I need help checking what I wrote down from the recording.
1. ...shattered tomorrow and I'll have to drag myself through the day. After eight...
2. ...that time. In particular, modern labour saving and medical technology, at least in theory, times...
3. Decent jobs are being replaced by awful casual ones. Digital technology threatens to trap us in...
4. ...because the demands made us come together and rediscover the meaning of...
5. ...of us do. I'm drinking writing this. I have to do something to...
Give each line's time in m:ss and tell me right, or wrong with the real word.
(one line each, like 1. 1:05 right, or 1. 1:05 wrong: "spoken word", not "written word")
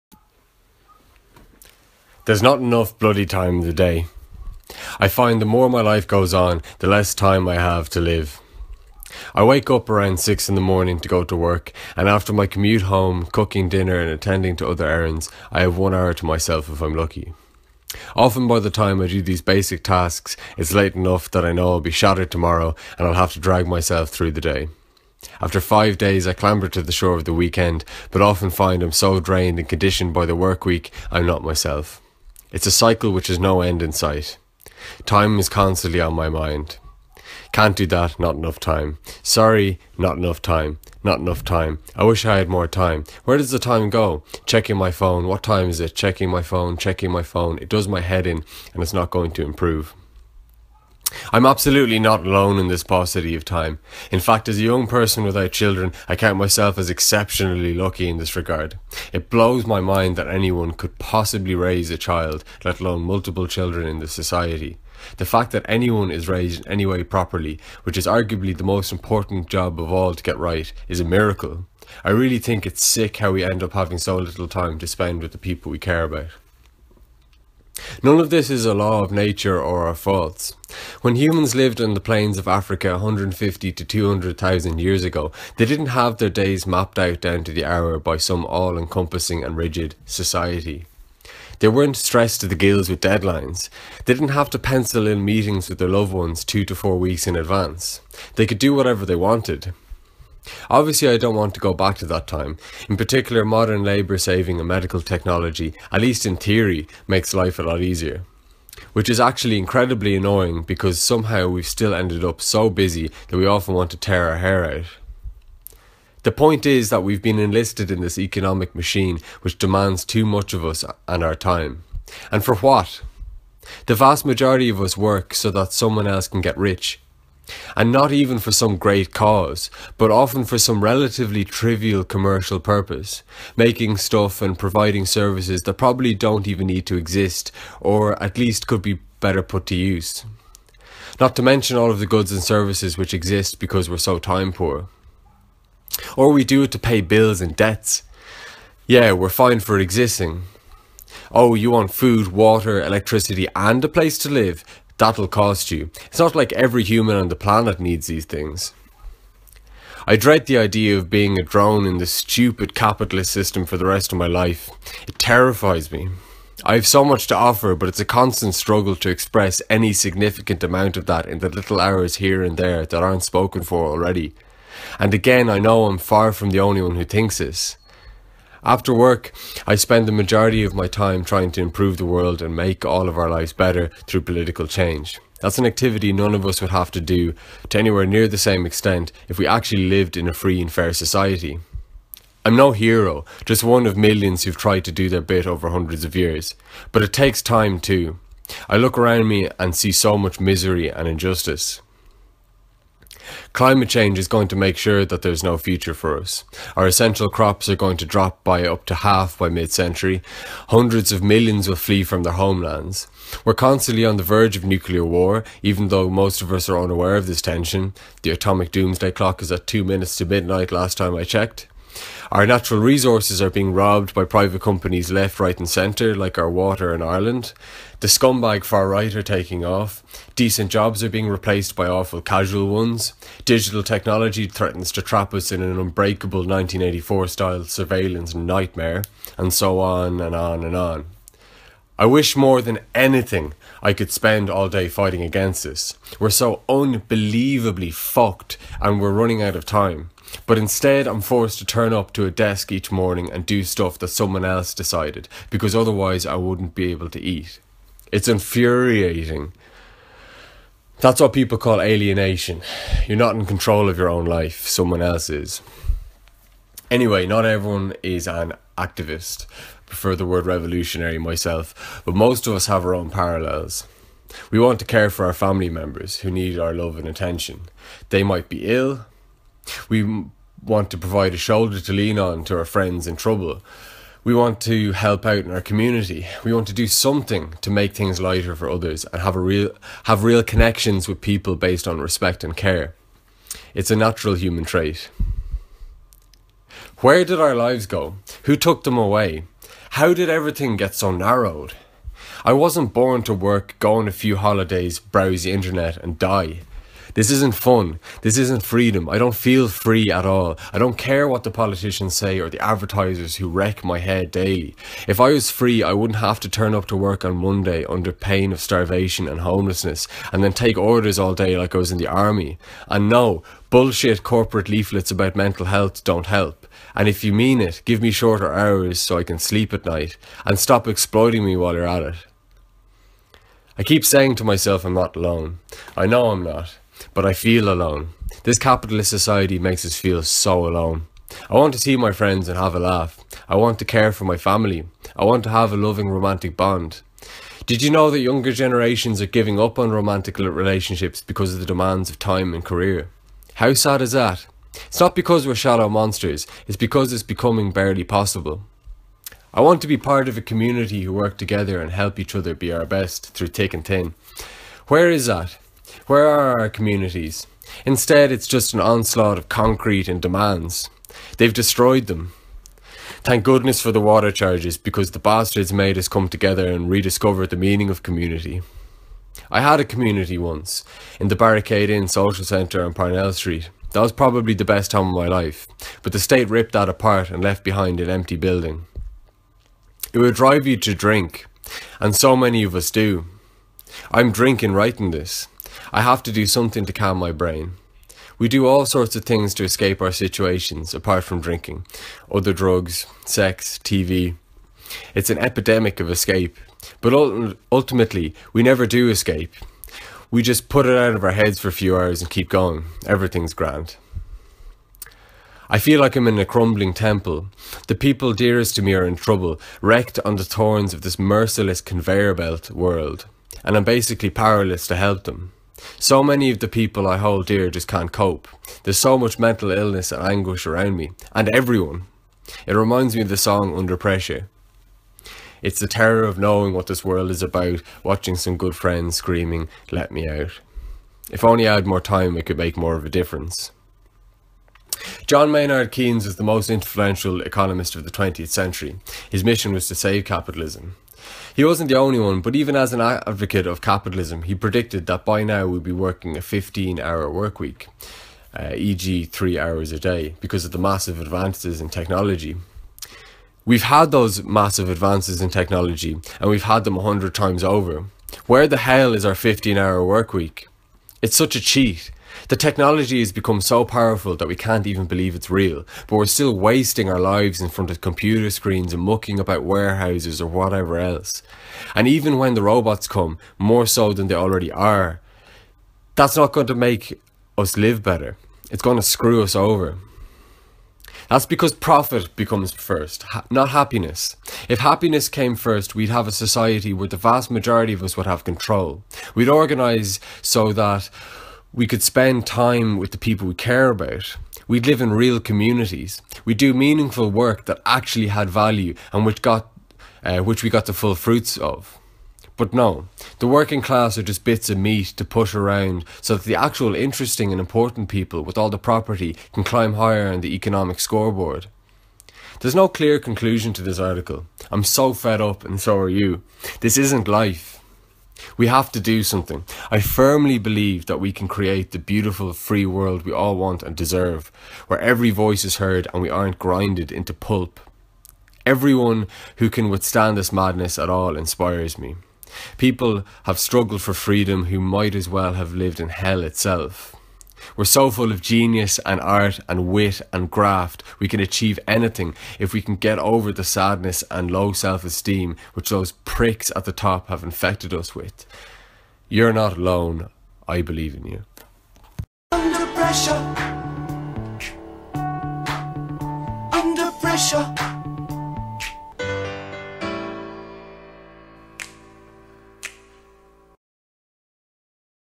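1. 0:21 wrong: "five", not "eight"
2. 1:42 wrong: "makes", not "times"
3. 3:50 right
4. 6:14 wrong: "bastards", not "demands"
5. 6:32 right.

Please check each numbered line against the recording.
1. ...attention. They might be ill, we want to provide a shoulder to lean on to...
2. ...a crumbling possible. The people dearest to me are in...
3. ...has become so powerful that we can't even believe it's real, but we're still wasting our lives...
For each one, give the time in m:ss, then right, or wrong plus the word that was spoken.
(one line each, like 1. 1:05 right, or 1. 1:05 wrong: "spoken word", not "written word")
1. 4:37 right
2. 6:56 wrong: "temple", not "possible"
3. 7:53 right.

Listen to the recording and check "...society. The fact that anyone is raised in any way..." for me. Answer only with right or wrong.
right.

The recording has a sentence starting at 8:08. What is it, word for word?
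It's going to screw us over.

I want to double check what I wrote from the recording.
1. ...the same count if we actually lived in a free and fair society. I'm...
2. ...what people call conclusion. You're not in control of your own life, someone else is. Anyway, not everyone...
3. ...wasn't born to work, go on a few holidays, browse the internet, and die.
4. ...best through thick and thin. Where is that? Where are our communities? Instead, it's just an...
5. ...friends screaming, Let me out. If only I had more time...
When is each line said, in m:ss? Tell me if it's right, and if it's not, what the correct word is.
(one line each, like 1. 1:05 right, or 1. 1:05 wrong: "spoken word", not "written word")
1. 3:08 wrong: "extent", not "count"
2. 4:21 wrong: "alienation", not "conclusion"
3. 5:02 right
4. 6:02 right
5. 7:18 right.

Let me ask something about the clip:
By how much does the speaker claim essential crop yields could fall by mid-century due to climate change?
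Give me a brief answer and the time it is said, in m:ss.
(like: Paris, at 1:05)
Up to half, at 3:28.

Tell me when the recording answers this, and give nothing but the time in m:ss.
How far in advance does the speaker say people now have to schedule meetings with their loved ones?
1:36.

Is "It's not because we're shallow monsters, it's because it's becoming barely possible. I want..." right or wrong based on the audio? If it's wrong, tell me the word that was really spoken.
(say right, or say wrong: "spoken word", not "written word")
right.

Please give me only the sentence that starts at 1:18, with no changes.
None of this is a law of nature or a faults.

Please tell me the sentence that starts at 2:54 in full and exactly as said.
And again, I know I'm far from the only one who thinks this.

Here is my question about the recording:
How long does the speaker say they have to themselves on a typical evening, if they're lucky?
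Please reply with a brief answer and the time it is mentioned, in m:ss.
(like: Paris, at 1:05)
One hour, at 0:15.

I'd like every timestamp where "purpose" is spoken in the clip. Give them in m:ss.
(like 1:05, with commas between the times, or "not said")
2:12.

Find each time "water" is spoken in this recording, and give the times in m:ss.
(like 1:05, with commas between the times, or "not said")
2:32, 3:46, 6:14.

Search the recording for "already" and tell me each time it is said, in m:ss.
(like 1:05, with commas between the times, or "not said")
2:53, 8:04.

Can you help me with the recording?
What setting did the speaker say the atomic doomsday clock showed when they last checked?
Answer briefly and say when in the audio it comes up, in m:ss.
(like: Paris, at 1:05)
Two minutes to midnight, at 3:39.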